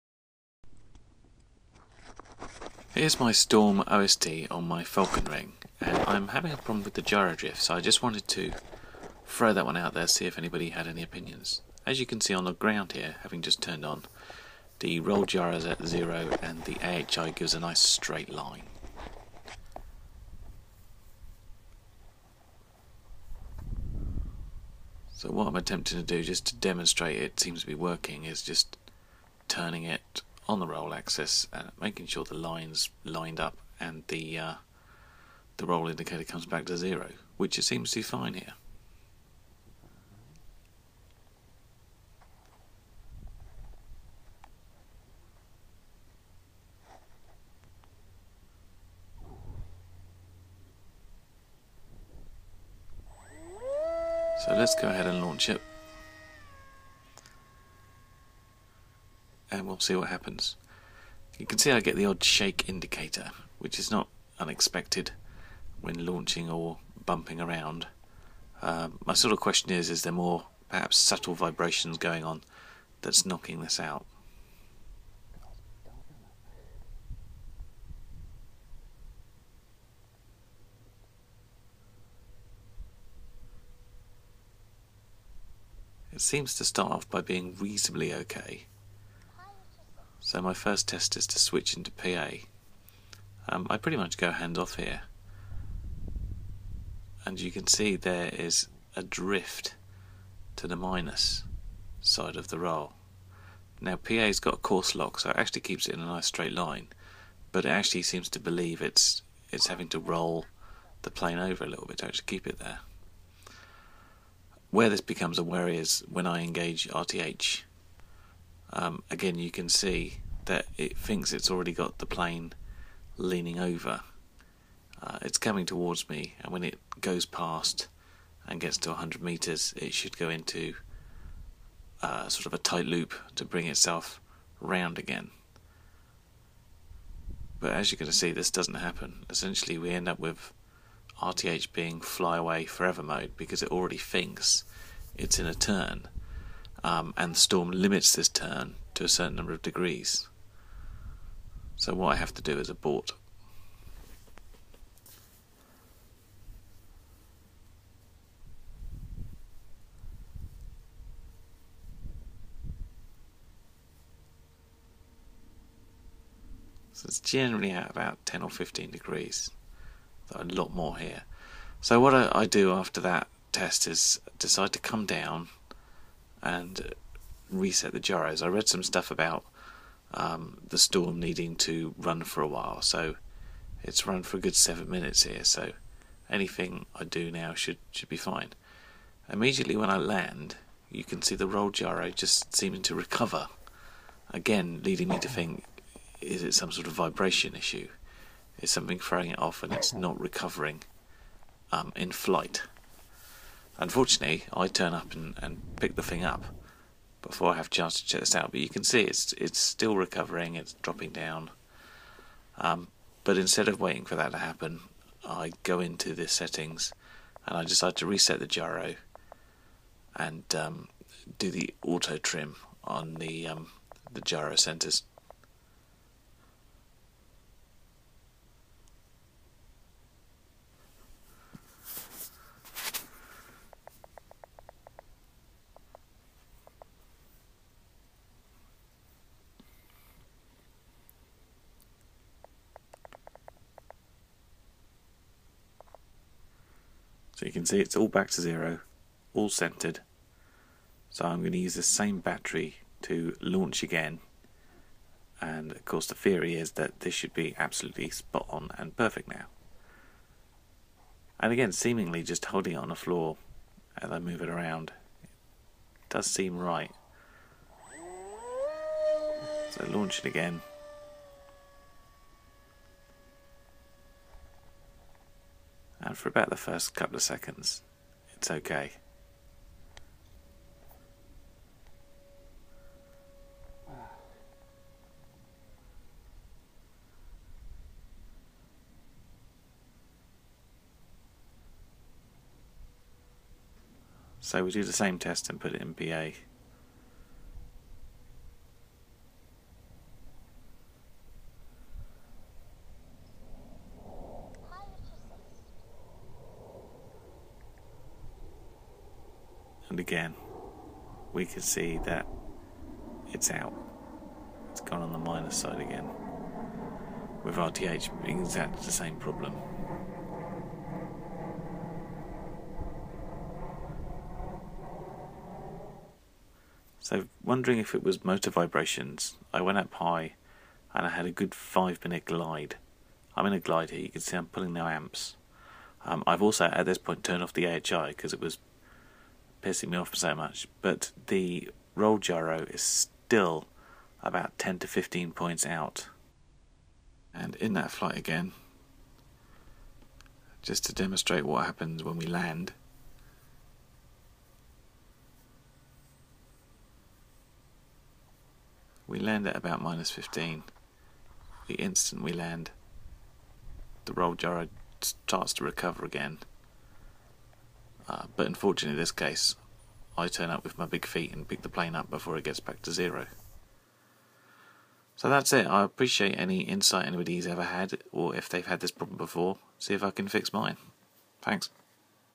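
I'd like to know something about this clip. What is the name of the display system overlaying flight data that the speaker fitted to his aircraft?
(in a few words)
Storm OSD.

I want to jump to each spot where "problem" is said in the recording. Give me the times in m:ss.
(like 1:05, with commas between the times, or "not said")
0:06, 5:19, 6:18.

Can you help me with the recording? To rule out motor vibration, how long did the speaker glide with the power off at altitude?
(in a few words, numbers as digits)
5 minutes.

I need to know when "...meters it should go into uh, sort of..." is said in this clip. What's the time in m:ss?
2:09.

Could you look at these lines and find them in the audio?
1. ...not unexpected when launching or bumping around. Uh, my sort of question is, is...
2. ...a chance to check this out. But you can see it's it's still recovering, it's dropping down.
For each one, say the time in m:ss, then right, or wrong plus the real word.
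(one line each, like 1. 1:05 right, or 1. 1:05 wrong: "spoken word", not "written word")
1. 1:03 right
2. 3:27 right.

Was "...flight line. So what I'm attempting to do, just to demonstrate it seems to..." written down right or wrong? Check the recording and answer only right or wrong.
wrong.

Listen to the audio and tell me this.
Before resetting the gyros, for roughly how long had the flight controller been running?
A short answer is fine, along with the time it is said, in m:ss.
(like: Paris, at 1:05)
7 minutes, at 3:04.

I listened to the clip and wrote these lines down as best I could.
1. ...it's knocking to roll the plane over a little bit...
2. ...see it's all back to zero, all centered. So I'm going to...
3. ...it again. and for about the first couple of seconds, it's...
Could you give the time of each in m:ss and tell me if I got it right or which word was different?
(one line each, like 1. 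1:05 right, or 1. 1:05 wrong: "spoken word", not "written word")
1. 1:49 wrong: "having", not "knocking"
2. 4:07 right
3. 4:30 right.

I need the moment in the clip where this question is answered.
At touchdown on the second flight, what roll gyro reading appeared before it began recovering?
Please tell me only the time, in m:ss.
5:59.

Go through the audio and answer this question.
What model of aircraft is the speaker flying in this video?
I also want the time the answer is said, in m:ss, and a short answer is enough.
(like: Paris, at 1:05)
Falcon Wing, at 0:04.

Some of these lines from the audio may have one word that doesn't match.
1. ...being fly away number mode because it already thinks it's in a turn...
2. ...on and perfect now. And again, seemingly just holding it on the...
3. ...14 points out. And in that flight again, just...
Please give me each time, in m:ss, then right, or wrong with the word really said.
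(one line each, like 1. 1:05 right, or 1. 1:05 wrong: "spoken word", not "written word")
1. 2:21 wrong: "forever", not "number"
2. 4:18 right
3. 5:44 wrong: "15", not "14".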